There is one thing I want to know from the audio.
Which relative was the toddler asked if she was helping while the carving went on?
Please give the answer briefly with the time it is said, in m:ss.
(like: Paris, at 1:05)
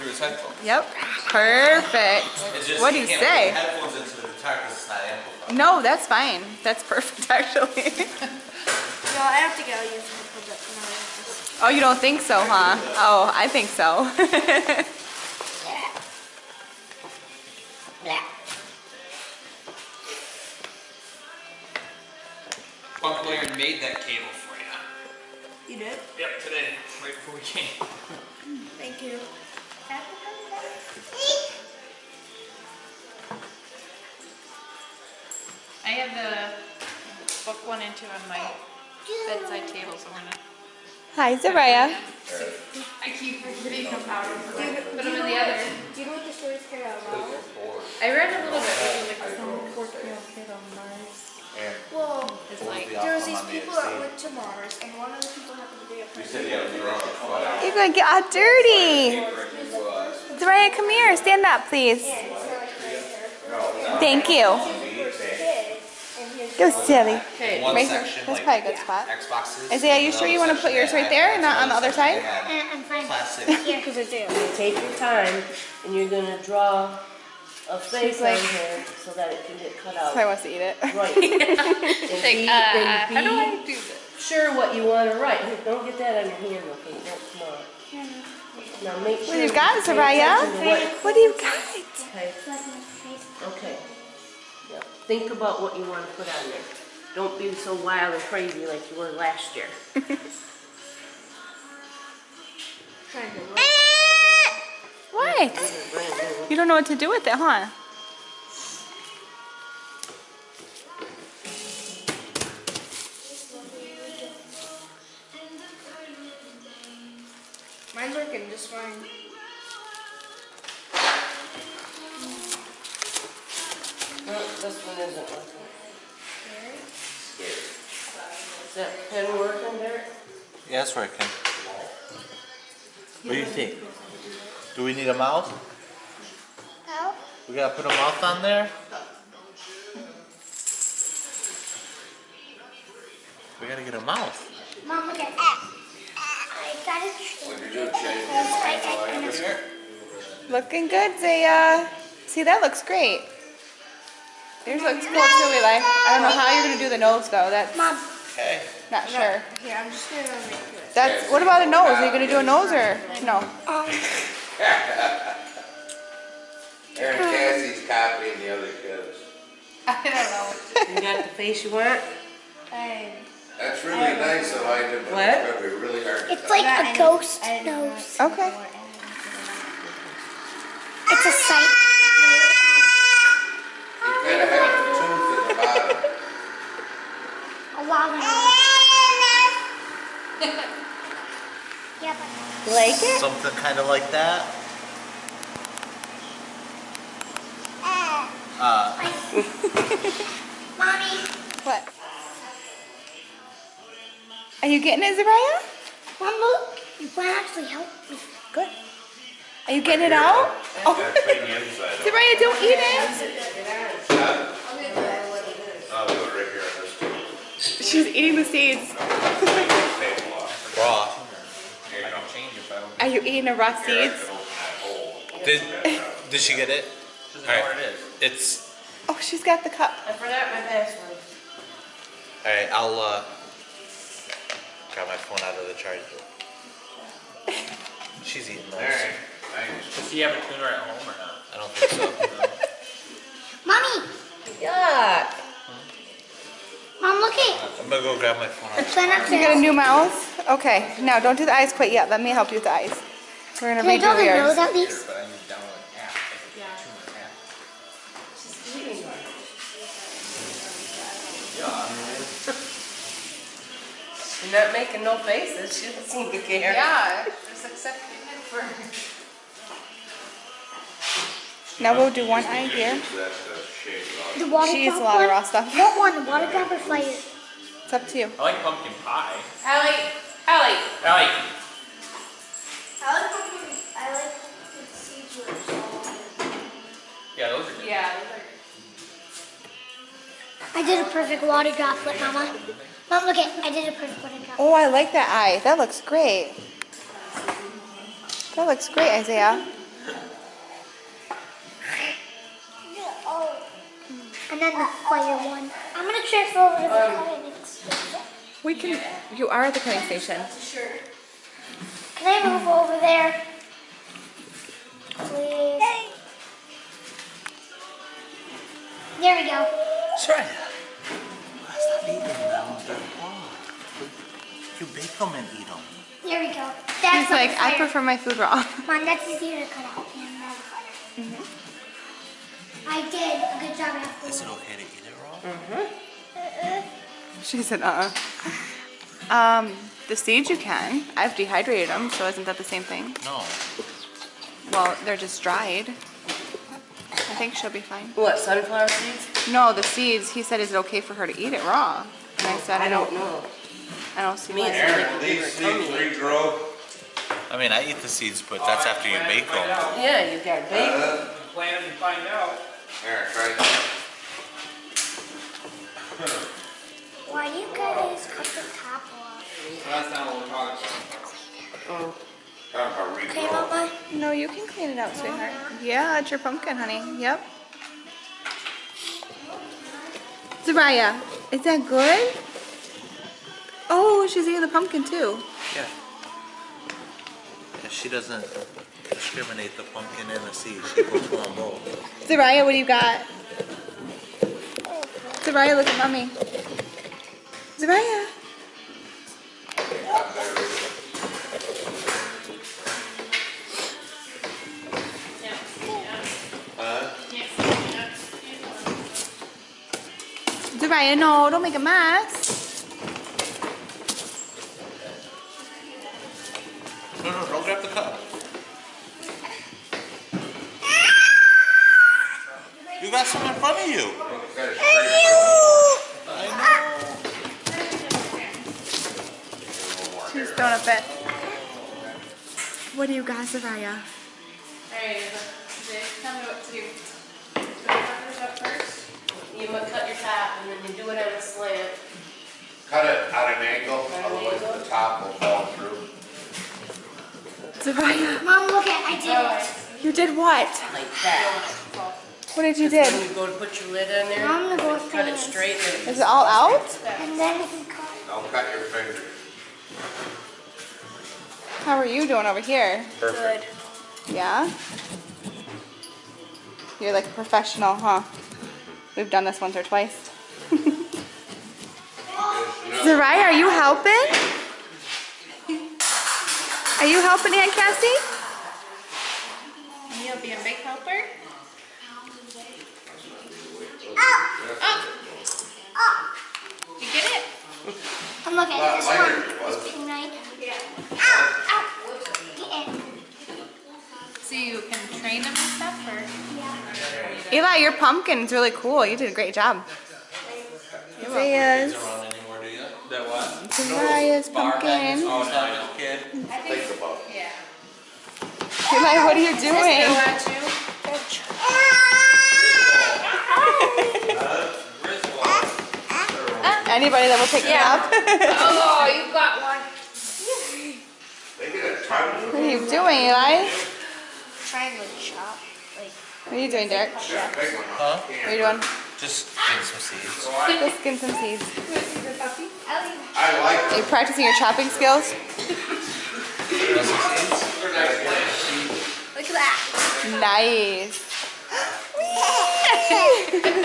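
Aunt Cassie, at 7:57.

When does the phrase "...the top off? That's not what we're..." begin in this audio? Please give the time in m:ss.
6:08.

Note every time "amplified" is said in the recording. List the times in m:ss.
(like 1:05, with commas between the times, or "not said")
0:05.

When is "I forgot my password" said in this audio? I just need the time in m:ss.
3:50.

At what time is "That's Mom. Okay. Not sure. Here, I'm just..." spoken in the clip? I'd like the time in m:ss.
2:37.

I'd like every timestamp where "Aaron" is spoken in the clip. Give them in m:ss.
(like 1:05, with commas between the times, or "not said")
2:46, 5:54, 6:03.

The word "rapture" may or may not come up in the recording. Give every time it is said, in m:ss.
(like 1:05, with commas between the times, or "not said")
not said.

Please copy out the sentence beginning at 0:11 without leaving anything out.
Oh, you don't think so, huh?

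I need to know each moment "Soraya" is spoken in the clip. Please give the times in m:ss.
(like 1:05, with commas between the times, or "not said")
1:29, 7:13, 7:27.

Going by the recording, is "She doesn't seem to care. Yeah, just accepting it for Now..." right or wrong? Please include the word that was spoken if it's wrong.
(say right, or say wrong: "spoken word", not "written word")
right.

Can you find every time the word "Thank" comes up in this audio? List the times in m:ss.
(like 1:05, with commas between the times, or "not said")
0:28, 1:03.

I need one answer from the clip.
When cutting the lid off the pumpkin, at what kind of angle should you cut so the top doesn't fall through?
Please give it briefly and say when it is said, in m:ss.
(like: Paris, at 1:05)
A slant, at 7:21.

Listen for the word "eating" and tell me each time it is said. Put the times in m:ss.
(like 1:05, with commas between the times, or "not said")
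3:38, 3:43, 3:58, 6:24.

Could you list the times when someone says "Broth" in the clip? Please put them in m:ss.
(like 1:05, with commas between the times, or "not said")
3:40.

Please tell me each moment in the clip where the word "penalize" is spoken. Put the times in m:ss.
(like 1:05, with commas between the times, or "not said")
not said.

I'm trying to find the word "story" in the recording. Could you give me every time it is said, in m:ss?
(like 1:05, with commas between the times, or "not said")
0:46.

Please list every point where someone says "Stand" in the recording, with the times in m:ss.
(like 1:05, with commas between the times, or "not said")
1:01.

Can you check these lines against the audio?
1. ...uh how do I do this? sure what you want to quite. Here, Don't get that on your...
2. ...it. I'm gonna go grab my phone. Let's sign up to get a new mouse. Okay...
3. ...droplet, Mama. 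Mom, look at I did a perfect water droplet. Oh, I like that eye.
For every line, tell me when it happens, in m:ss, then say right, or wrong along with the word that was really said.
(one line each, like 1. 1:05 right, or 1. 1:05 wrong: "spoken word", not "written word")
1. 1:22 wrong: "write", not "quite"
2. 4:07 right
3. 4:51 right.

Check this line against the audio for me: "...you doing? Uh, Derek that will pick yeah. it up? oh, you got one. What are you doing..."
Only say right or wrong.
wrong.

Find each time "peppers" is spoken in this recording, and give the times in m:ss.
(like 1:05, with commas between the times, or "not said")
7:17.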